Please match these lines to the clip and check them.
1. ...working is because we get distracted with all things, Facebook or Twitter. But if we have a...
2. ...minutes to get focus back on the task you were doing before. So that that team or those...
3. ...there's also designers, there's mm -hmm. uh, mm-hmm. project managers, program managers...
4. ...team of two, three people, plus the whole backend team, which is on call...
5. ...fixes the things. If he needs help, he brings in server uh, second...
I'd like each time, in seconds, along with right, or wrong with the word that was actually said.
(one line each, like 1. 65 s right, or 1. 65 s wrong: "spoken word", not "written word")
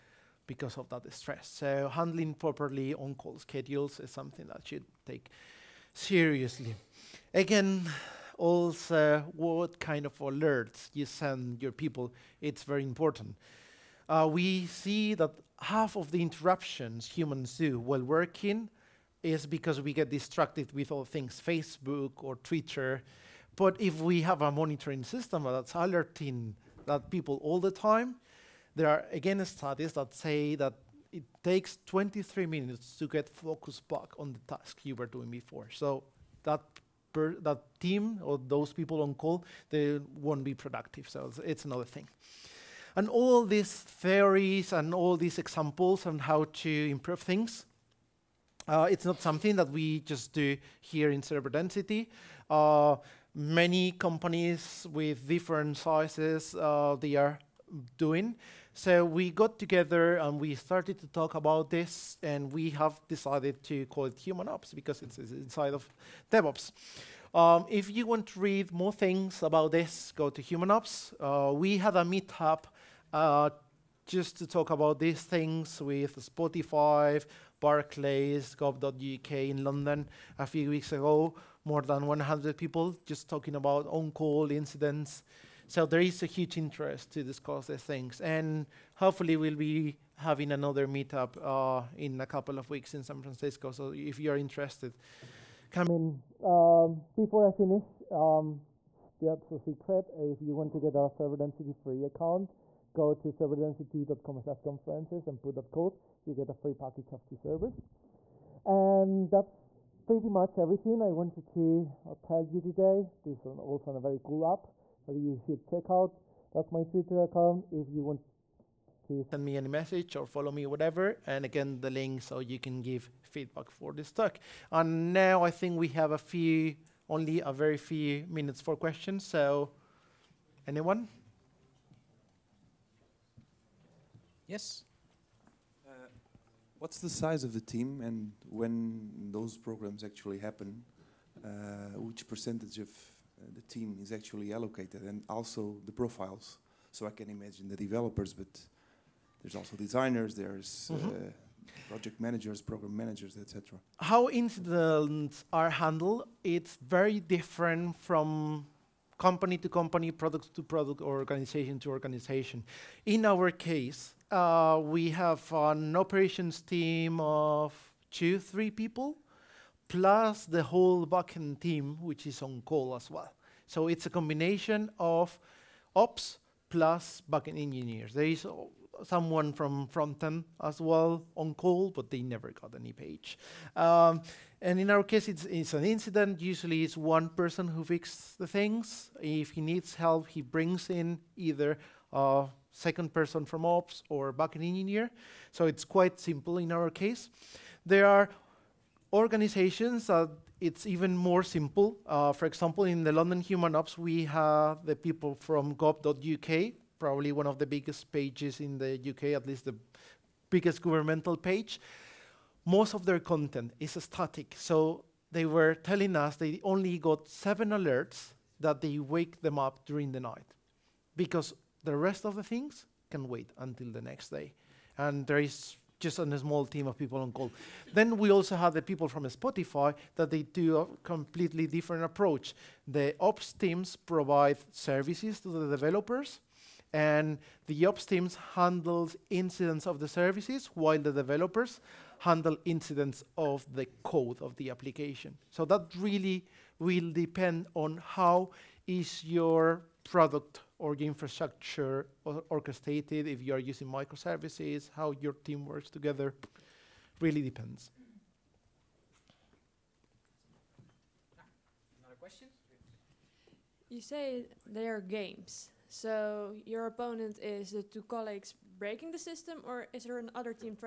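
1. 18 s right
2. 32 s right
3. 149 s right
4. 166 s right
5. 187 s wrong: "either", not "server".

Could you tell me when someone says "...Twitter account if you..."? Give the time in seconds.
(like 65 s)
116 s.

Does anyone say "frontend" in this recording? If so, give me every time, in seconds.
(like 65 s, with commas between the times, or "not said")
179 s.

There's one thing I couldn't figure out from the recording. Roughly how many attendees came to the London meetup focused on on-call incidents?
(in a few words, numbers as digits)
More than 100.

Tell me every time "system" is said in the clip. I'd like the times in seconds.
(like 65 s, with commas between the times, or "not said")
25 s, 269 s.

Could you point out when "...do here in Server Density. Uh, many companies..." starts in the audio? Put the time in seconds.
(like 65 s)
50 s.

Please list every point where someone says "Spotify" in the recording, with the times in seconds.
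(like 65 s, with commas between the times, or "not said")
76 s, 229 s.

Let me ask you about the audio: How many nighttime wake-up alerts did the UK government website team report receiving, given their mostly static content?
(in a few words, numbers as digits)
7.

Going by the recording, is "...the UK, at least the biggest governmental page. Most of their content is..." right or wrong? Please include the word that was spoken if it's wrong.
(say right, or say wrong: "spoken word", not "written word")
right.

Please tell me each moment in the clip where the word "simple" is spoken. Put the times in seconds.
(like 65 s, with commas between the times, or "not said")
196 s, 201 s.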